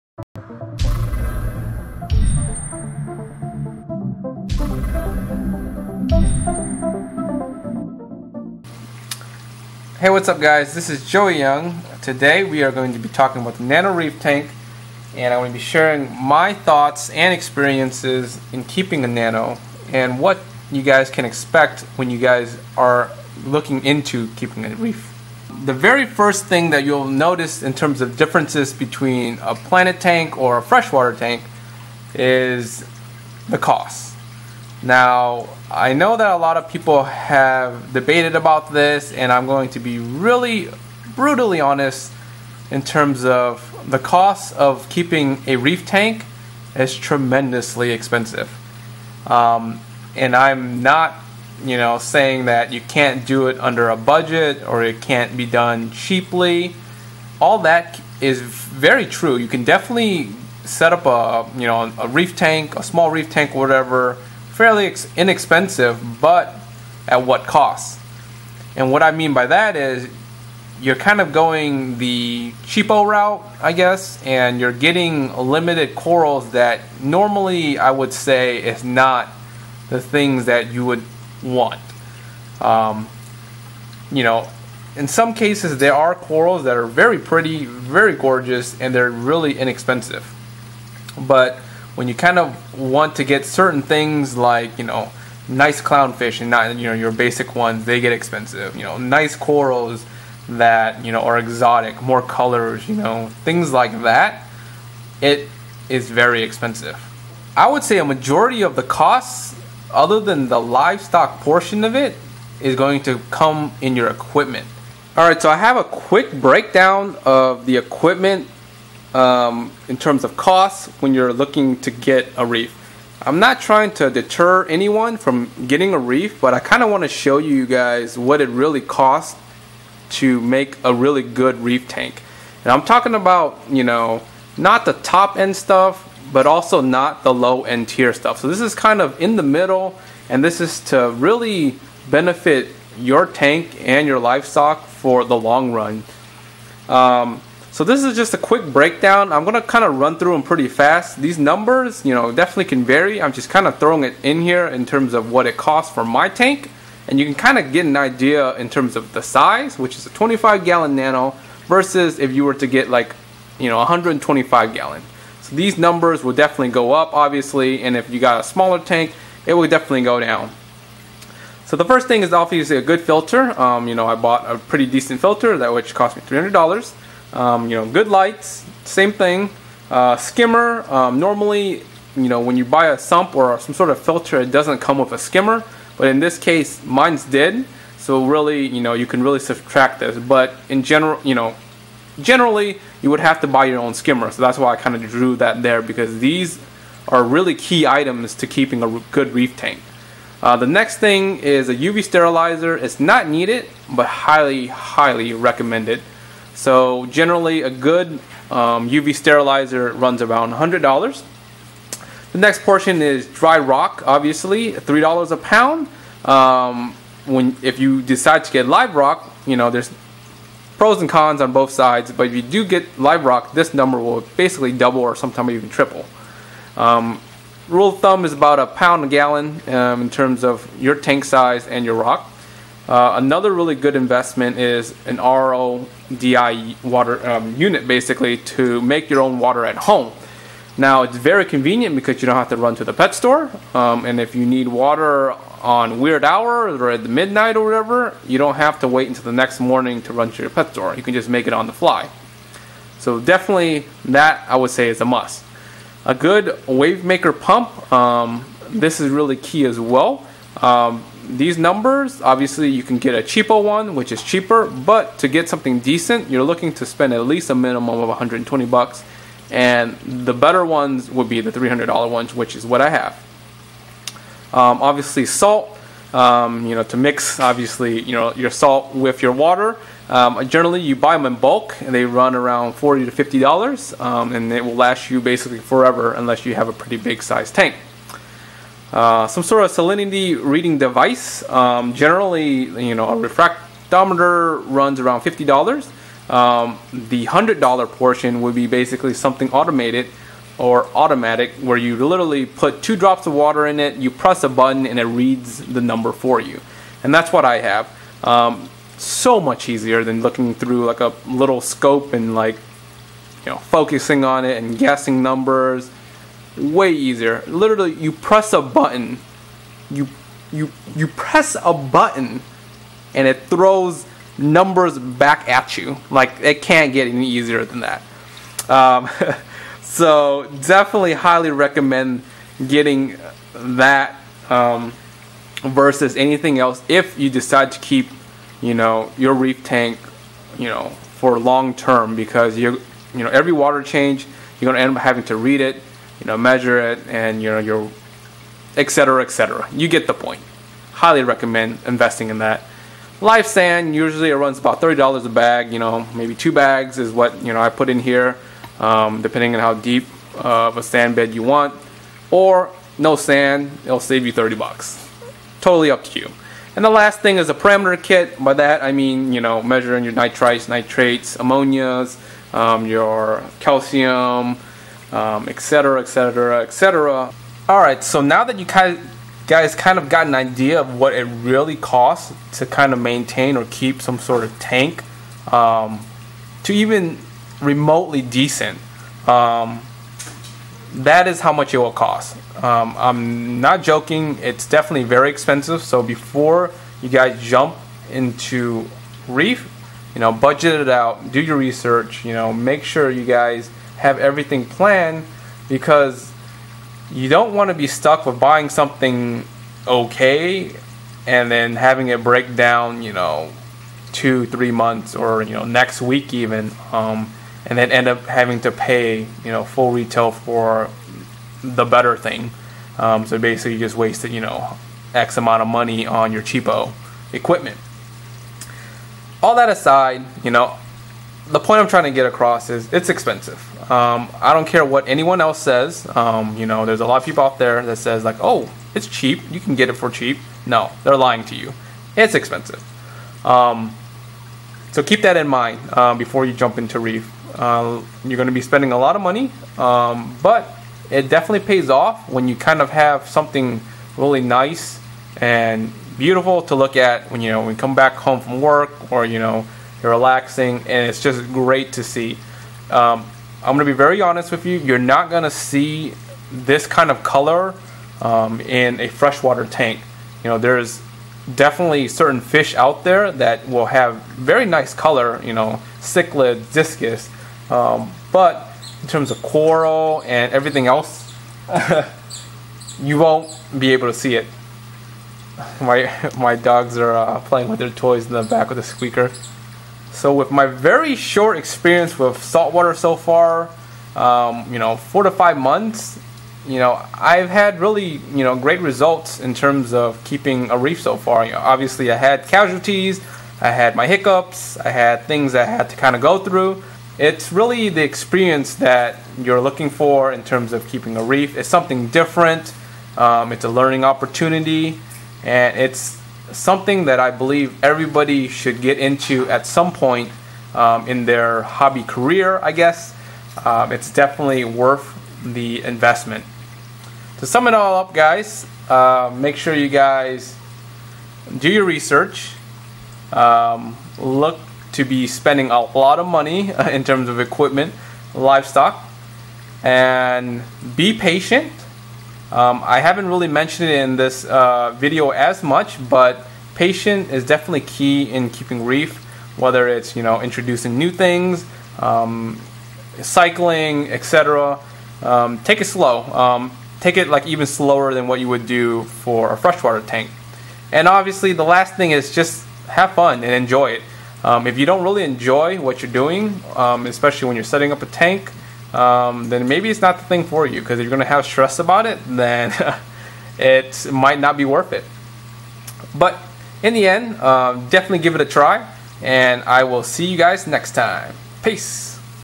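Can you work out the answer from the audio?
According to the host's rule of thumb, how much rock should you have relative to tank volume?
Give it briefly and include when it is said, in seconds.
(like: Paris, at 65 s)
a pound a gallon, at 228 s.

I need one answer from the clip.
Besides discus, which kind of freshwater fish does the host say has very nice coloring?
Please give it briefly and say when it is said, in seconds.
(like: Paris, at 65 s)
cichlid, at 475 s.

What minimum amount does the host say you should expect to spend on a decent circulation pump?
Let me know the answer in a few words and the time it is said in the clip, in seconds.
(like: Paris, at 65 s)
$120, at 268 s.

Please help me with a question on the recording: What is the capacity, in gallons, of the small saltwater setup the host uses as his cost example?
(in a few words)
25 gallon.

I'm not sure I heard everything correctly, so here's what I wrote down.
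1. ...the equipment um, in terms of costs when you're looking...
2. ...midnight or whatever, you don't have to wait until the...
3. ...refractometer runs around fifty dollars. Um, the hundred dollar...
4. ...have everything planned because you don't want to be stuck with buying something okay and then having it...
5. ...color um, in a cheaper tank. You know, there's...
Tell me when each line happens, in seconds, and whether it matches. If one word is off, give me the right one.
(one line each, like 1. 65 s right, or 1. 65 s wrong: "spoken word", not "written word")
1. 117 s right
2. 247 s right
3. 293 s right
4. 403 s right
5. 467 s wrong: "freshwater", not "cheaper".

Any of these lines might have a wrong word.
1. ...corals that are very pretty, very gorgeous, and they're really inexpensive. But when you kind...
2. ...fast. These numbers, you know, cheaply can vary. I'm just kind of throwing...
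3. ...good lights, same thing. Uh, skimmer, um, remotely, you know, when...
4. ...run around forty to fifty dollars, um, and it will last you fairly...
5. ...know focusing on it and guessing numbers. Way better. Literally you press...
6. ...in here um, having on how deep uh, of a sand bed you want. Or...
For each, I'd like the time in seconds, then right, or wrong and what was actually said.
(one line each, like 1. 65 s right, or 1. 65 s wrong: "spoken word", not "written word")
1. 86 s right
2. 150 s wrong: "definitely", not "cheaply"
3. 177 s wrong: "normally", not "remotely"
4. 282 s wrong: "basically", not "fairly"
5. 313 s wrong: "easier", not "better"
6. 357 s wrong: "depending", not "having".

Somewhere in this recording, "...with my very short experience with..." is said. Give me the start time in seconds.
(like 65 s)
490 s.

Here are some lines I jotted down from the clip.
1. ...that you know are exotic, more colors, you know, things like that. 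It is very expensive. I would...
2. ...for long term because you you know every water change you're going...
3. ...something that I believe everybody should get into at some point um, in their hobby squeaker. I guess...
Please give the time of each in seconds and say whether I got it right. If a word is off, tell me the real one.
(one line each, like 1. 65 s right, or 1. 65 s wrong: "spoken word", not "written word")
1. 100 s right
2. 341 s right
3. 516 s wrong: "career", not "squeaker".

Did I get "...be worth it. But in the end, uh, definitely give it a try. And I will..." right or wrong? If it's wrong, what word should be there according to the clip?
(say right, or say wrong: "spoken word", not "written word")
right.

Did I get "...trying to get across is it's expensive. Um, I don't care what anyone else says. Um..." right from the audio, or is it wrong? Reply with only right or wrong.
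right.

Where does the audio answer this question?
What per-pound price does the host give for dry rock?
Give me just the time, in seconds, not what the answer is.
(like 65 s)
214 s.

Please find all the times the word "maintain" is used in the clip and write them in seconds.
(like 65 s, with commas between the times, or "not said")
382 s.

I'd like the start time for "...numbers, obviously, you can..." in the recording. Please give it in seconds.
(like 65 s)
261 s.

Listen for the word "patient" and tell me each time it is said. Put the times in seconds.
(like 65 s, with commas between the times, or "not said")
541 s, 546 s.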